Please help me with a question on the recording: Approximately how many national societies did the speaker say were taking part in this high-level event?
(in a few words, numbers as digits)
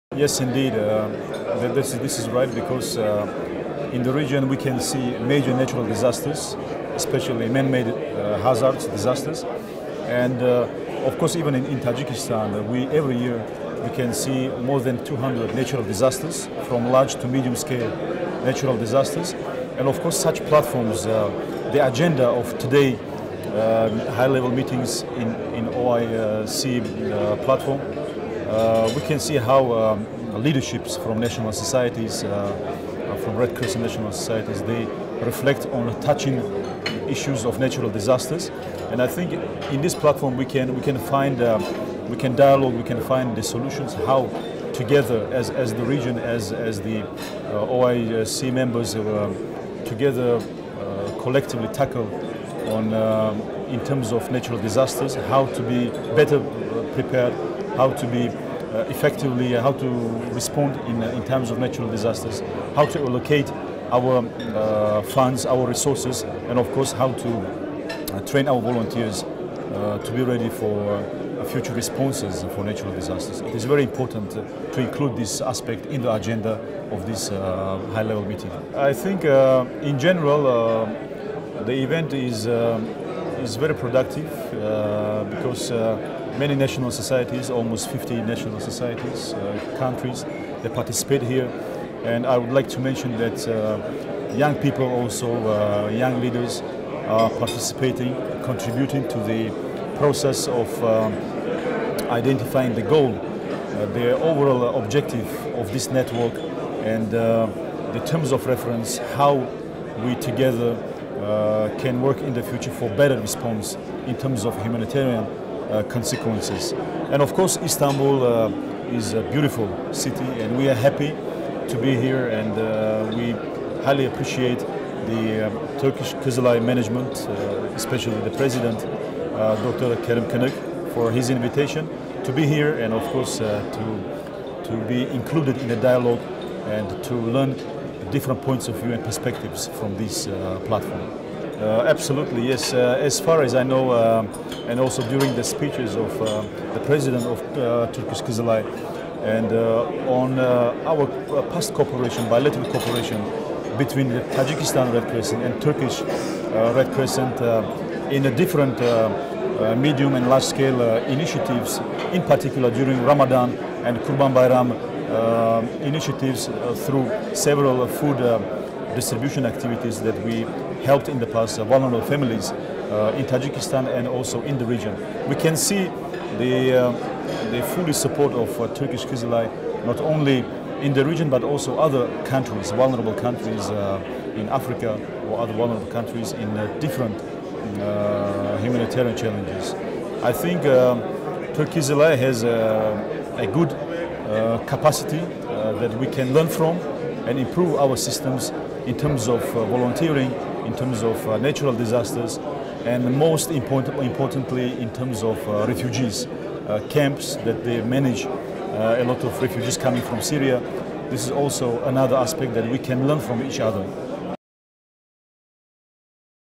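almost 50.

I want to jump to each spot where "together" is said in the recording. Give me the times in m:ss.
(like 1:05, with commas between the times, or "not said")
0:44, 0:49, 1:50.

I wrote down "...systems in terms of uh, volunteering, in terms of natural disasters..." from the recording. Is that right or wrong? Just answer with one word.
right.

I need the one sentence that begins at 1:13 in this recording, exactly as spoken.
It is very important to include this aspect in the agenda of this high-level meeting.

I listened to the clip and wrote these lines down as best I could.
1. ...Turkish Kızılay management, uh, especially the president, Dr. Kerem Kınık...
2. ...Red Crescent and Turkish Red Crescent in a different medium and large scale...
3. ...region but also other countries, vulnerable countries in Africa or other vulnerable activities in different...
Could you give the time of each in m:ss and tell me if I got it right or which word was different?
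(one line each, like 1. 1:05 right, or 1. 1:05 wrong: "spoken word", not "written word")
1. 2:05 right
2. 2:34 right
3. 3:01 wrong: "countries", not "activities".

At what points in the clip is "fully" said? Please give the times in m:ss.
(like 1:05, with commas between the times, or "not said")
2:57.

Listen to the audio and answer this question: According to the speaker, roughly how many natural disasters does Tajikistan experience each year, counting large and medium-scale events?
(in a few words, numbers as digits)
more than 200.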